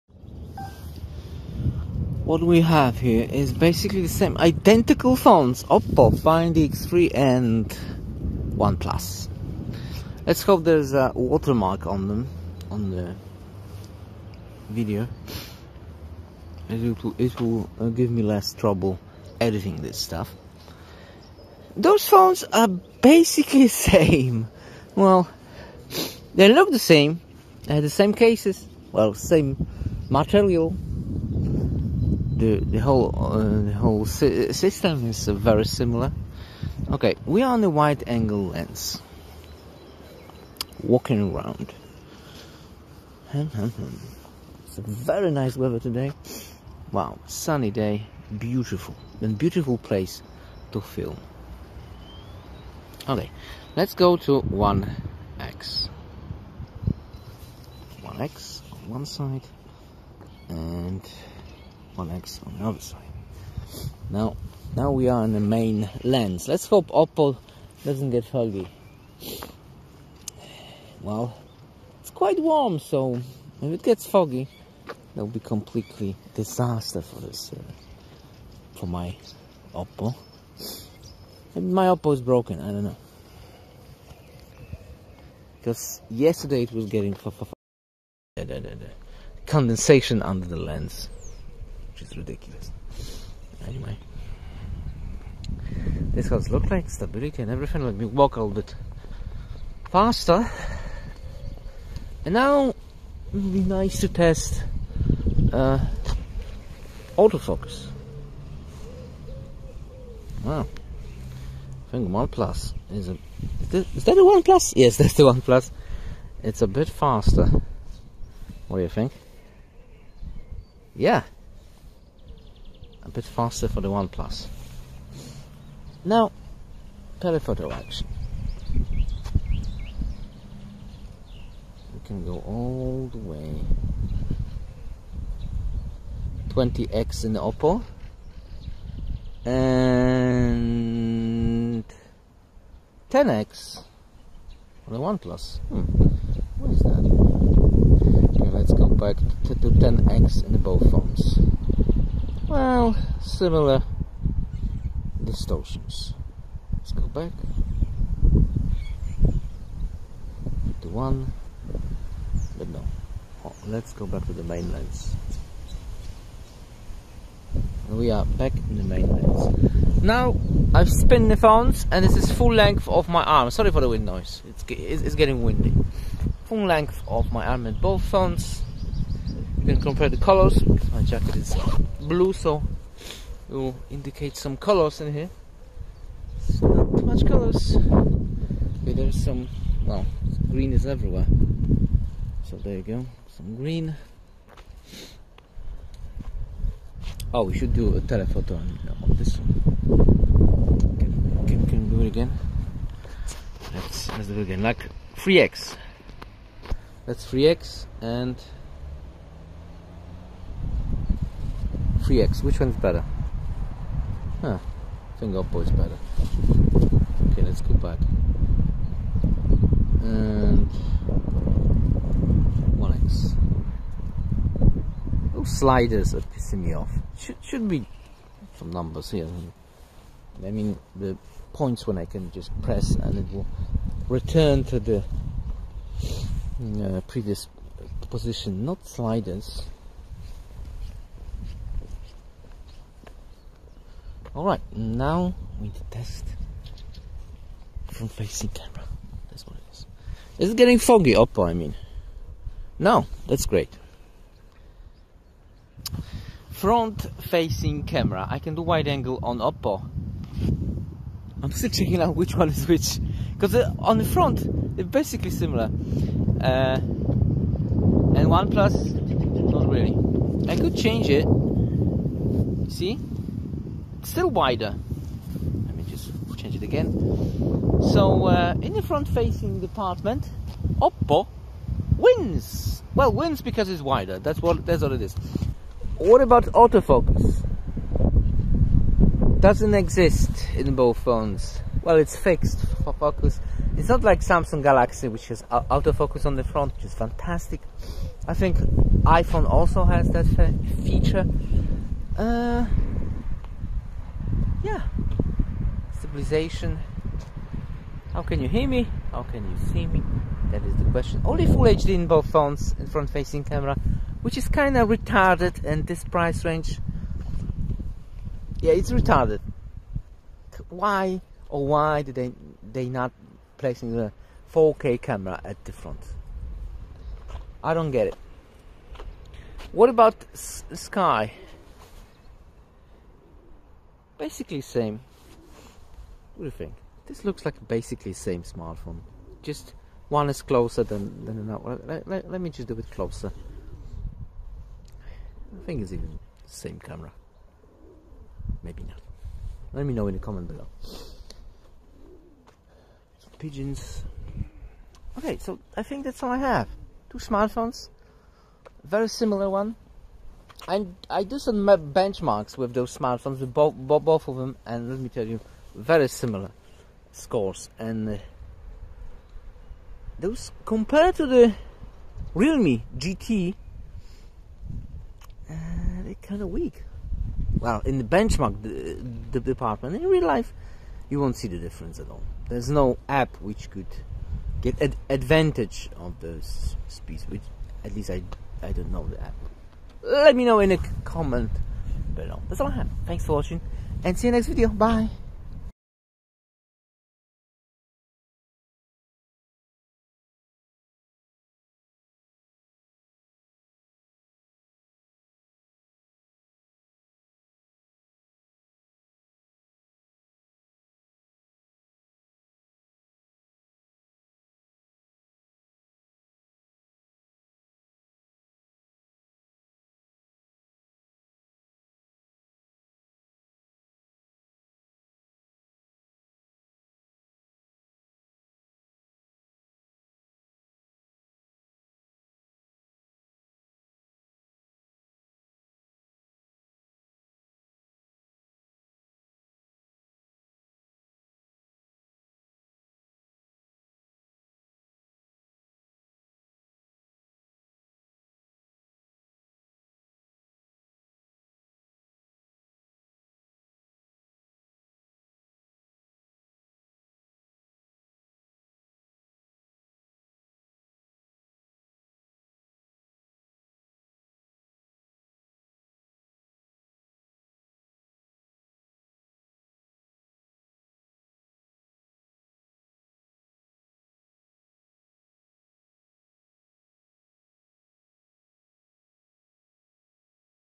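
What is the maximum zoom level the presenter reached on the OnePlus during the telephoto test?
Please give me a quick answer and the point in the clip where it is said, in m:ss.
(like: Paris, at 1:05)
10x, at 2:23.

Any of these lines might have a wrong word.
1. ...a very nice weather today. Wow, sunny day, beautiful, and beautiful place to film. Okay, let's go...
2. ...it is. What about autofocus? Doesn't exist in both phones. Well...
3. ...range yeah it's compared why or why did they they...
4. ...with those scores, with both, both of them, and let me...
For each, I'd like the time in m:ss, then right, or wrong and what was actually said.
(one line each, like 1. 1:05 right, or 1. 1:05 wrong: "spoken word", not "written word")
1. 0:44 right
2. 4:44 right
3. 5:16 wrong: "retarded", not "compared"
4. 6:02 wrong: "smartphones", not "scores".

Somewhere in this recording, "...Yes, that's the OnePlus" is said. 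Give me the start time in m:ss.
1:54.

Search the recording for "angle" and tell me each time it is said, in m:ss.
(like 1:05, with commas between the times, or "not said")
0:37, 4:18.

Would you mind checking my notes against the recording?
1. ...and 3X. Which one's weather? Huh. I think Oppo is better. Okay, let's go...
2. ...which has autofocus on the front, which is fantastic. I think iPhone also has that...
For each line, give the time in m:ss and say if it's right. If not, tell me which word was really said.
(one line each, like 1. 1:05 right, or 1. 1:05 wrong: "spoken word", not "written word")
1. 3:28 wrong: "better", not "weather"
2. 4:55 right.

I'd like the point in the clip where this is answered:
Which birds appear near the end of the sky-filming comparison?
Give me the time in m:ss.
5:53.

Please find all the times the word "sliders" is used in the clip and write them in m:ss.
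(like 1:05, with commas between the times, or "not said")
3:45, 3:58.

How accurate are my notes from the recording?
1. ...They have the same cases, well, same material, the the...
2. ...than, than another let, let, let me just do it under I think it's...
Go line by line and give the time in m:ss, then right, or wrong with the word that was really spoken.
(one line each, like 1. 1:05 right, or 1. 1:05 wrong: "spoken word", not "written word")
1. 0:27 right
2. 5:40 wrong: "closer", not "under".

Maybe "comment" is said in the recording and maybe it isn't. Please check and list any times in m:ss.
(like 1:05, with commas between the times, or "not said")
5:50, 6:31.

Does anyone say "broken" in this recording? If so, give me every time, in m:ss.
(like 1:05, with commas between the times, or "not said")
1:22.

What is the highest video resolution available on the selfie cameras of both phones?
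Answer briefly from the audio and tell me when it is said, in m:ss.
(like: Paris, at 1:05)
Full HD, at 5:11.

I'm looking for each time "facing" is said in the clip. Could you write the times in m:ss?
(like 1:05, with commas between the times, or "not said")
4:08, 4:17, 4:39, 5:13.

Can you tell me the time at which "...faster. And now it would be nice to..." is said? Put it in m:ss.
1:39.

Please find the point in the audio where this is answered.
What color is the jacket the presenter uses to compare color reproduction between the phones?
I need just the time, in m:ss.
3:02.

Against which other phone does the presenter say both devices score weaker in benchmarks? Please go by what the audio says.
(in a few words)
Realme GT.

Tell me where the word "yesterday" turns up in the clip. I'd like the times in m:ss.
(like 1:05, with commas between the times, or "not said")
1:26.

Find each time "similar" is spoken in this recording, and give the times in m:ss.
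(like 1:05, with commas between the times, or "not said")
0:35, 2:33, 4:25, 5:59, 6:06.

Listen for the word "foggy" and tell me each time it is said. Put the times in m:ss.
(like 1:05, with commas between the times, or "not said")
1:08, 1:14, 4:10.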